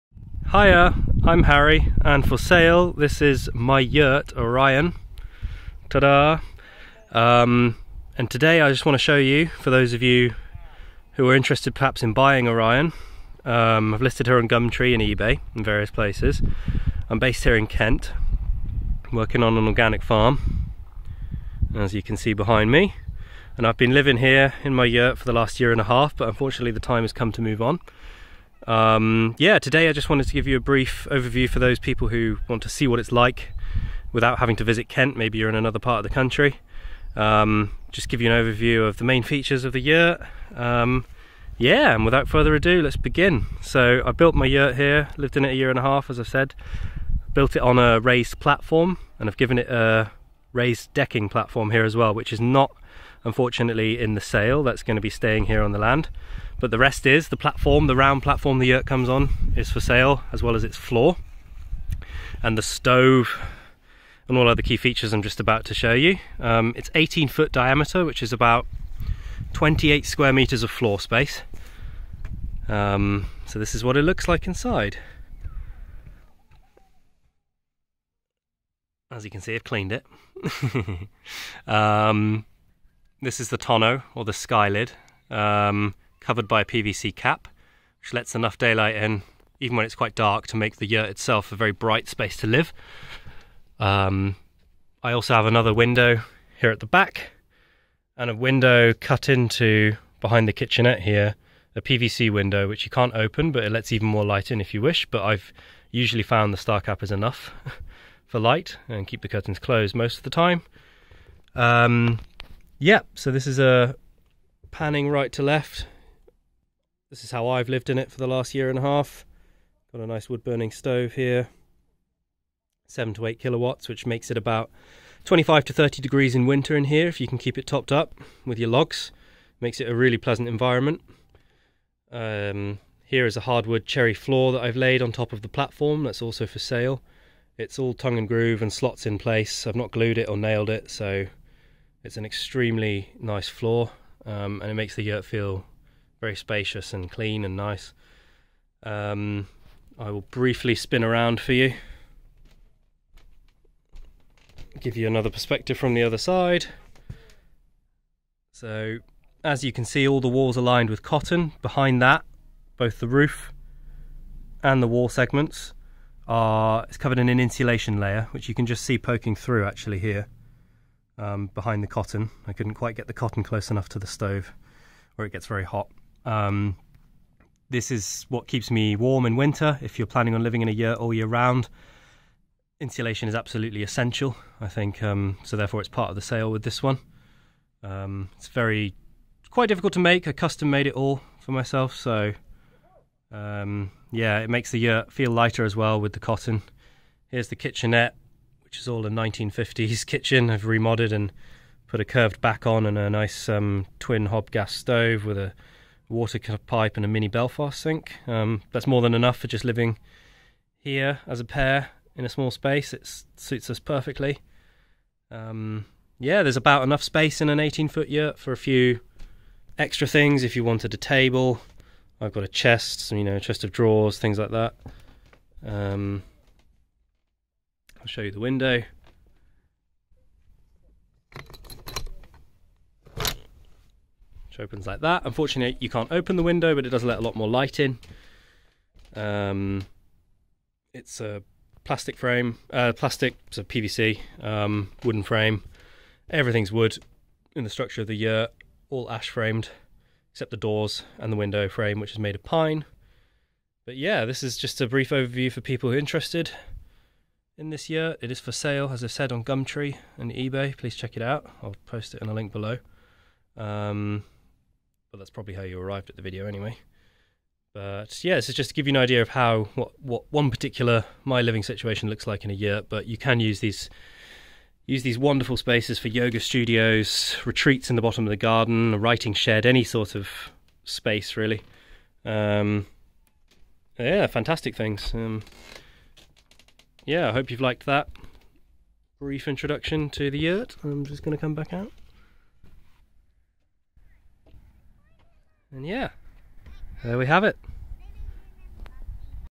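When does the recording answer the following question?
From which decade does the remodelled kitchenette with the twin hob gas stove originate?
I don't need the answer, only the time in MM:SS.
03:19.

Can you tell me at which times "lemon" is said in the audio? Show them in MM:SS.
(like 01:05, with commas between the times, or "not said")
not said.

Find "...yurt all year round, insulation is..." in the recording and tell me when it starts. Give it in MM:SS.
03:00.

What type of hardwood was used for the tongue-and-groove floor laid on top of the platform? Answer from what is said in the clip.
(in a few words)
Cherry.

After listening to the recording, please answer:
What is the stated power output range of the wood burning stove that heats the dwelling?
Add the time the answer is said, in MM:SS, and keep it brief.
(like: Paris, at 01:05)
7 to 8 kilowatts, at 02:02.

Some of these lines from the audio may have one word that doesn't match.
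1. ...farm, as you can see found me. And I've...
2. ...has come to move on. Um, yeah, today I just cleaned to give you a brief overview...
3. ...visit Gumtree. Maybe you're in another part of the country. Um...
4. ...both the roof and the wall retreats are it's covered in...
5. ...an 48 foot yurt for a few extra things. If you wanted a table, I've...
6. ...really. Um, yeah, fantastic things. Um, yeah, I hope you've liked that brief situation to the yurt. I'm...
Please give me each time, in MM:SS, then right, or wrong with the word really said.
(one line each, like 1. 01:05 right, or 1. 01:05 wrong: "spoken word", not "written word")
1. 00:20 wrong: "behind", not "found"
2. 00:27 wrong: "wanted", not "cleaned"
3. 00:34 wrong: "Kent", not "Gumtree"
4. 02:42 wrong: "segments", not "retreats"
5. 03:37 wrong: "18", not "48"
6. 04:41 wrong: "introduction", not "situation".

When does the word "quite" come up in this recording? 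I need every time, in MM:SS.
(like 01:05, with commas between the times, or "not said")
01:29, 02:52, 03:09.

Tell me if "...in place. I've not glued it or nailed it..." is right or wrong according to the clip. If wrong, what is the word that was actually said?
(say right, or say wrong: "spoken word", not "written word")
right.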